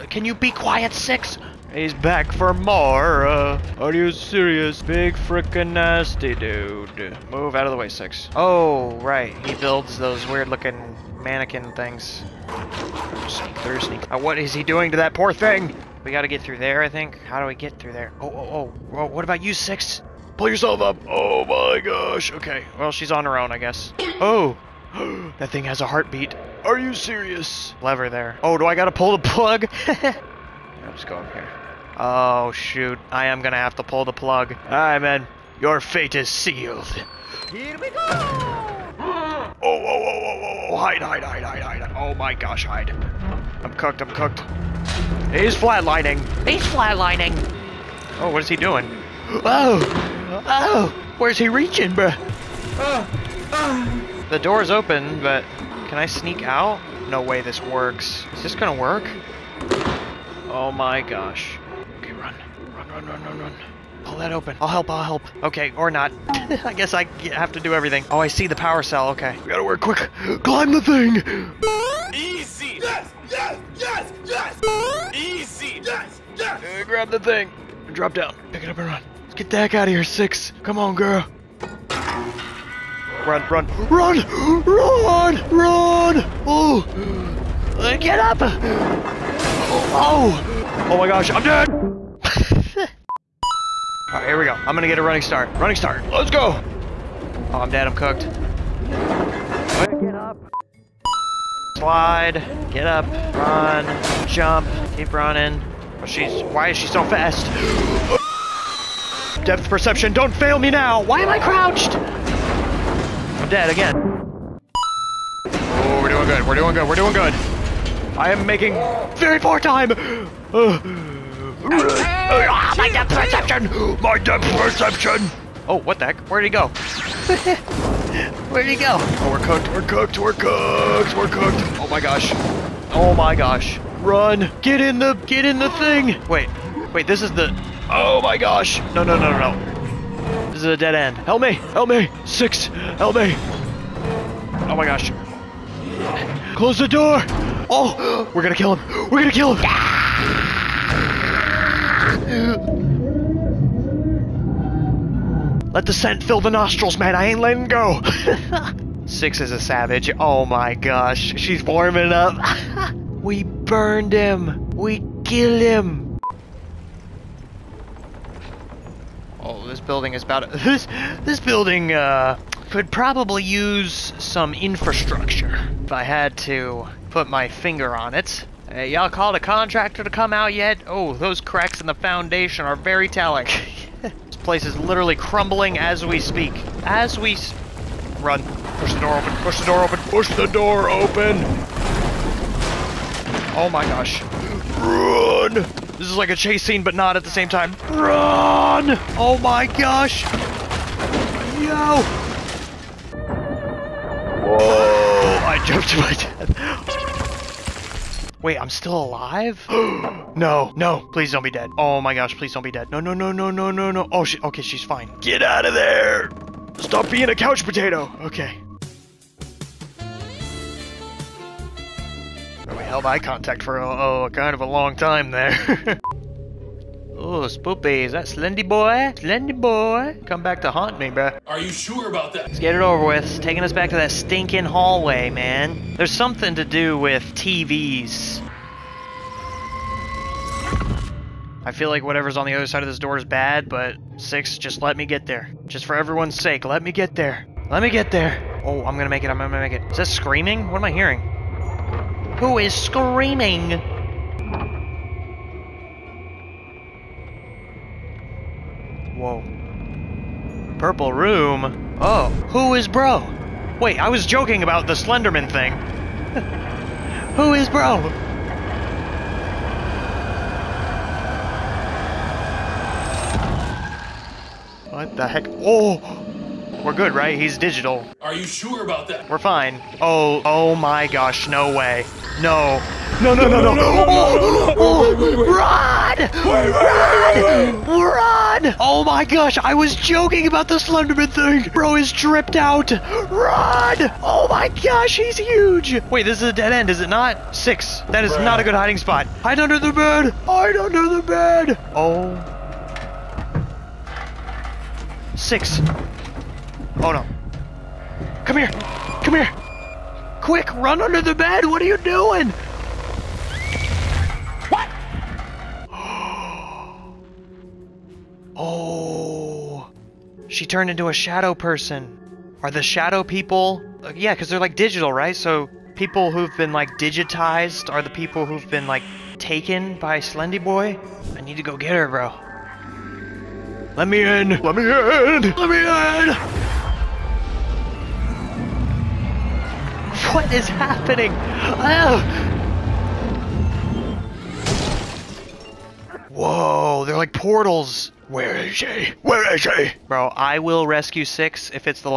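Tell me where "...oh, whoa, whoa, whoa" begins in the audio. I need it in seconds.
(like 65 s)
40 s.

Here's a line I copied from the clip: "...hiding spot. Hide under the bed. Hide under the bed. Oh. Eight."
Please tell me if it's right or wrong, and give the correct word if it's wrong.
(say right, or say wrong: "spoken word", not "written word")
wrong: "Six", not "Eight".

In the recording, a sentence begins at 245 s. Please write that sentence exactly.
Just for everyone's sake, let me get there.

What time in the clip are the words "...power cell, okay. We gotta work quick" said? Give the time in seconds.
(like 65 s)
68 s.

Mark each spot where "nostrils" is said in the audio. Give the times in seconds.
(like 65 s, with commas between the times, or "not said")
156 s.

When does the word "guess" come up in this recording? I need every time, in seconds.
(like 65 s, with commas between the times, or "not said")
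23 s, 66 s.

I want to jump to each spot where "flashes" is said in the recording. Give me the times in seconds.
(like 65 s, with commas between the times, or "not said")
not said.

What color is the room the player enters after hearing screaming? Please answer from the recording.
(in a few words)
Purple.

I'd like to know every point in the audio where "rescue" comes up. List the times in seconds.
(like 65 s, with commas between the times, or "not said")
350 s.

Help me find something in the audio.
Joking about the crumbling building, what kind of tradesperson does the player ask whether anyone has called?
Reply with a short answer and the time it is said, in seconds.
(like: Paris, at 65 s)
A contractor, at 179 s.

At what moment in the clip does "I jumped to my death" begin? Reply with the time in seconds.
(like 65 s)
205 s.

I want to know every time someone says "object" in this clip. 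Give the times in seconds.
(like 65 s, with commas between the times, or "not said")
not said.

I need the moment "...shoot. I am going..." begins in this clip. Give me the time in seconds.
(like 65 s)
32 s.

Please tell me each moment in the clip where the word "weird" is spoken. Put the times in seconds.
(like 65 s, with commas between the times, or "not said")
10 s.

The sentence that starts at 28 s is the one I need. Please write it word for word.
Oh, do I gotta pull the plug?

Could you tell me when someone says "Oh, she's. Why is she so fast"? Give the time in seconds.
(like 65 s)
105 s.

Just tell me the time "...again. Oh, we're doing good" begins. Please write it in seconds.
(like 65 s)
113 s.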